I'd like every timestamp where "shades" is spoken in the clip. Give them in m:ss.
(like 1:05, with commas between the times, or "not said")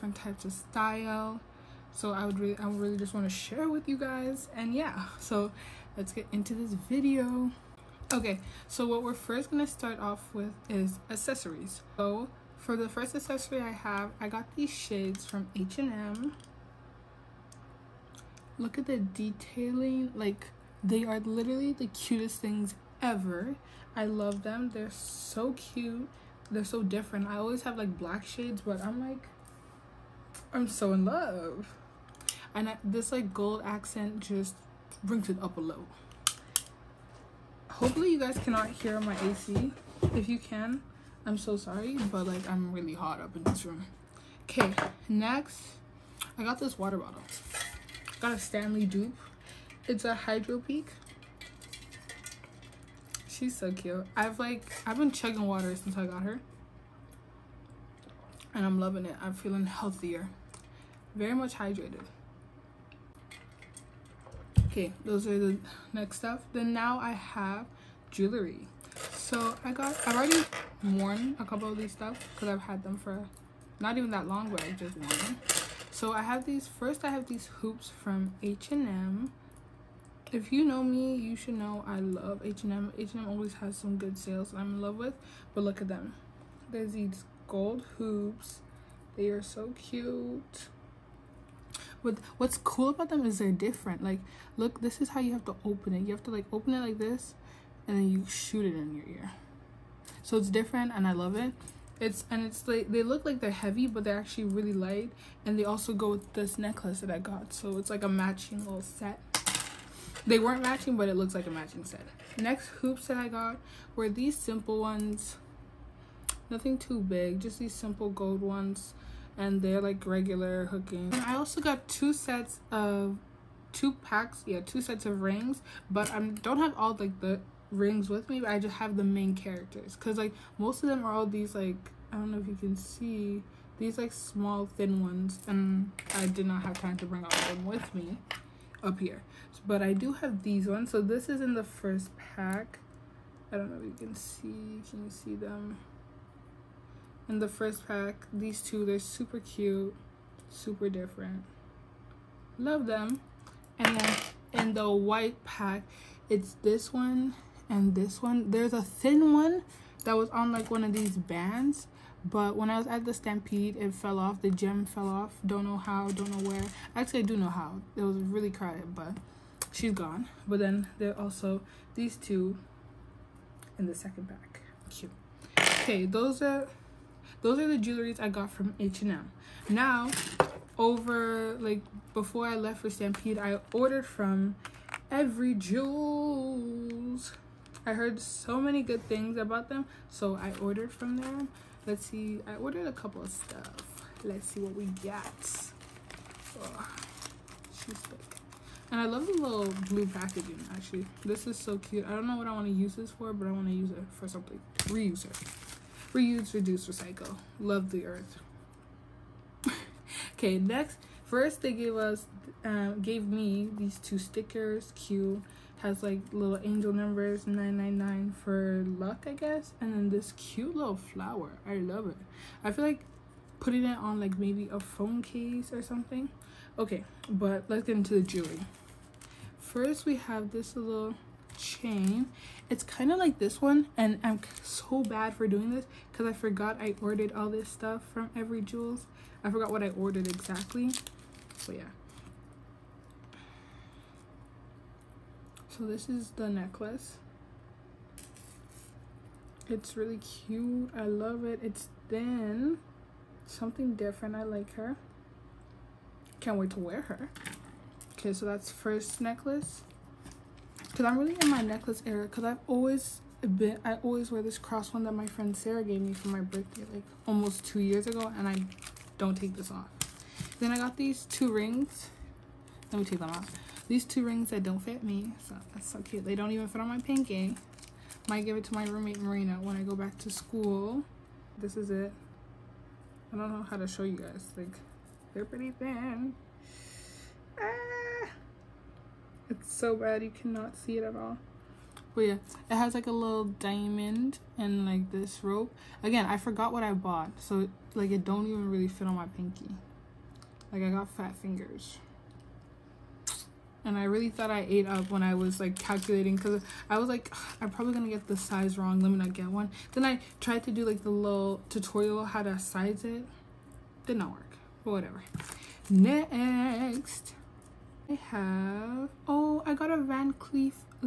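0:14, 0:28.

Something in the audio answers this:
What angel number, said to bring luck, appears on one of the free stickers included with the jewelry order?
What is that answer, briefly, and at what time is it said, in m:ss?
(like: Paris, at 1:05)
999, at 3:37.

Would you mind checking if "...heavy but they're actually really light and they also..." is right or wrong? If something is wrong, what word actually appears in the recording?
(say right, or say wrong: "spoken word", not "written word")
right.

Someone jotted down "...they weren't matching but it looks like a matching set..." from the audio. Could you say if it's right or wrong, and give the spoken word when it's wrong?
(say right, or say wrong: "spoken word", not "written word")
right.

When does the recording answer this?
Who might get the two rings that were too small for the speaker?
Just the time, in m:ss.
4:39.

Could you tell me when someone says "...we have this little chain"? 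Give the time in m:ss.
3:50.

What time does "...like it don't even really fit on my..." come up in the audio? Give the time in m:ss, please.
4:57.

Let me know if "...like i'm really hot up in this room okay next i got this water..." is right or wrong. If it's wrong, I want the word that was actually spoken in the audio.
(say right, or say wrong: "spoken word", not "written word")
right.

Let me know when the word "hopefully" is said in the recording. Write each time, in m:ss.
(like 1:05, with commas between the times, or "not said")
0:37.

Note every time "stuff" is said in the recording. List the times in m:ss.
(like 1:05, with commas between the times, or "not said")
1:06, 1:11, 3:13, 3:57.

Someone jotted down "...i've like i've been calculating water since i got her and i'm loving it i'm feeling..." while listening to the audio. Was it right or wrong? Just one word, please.
wrong.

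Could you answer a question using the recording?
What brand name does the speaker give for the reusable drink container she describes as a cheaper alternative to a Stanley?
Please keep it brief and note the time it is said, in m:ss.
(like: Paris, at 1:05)
Hydro Peak, at 0:50.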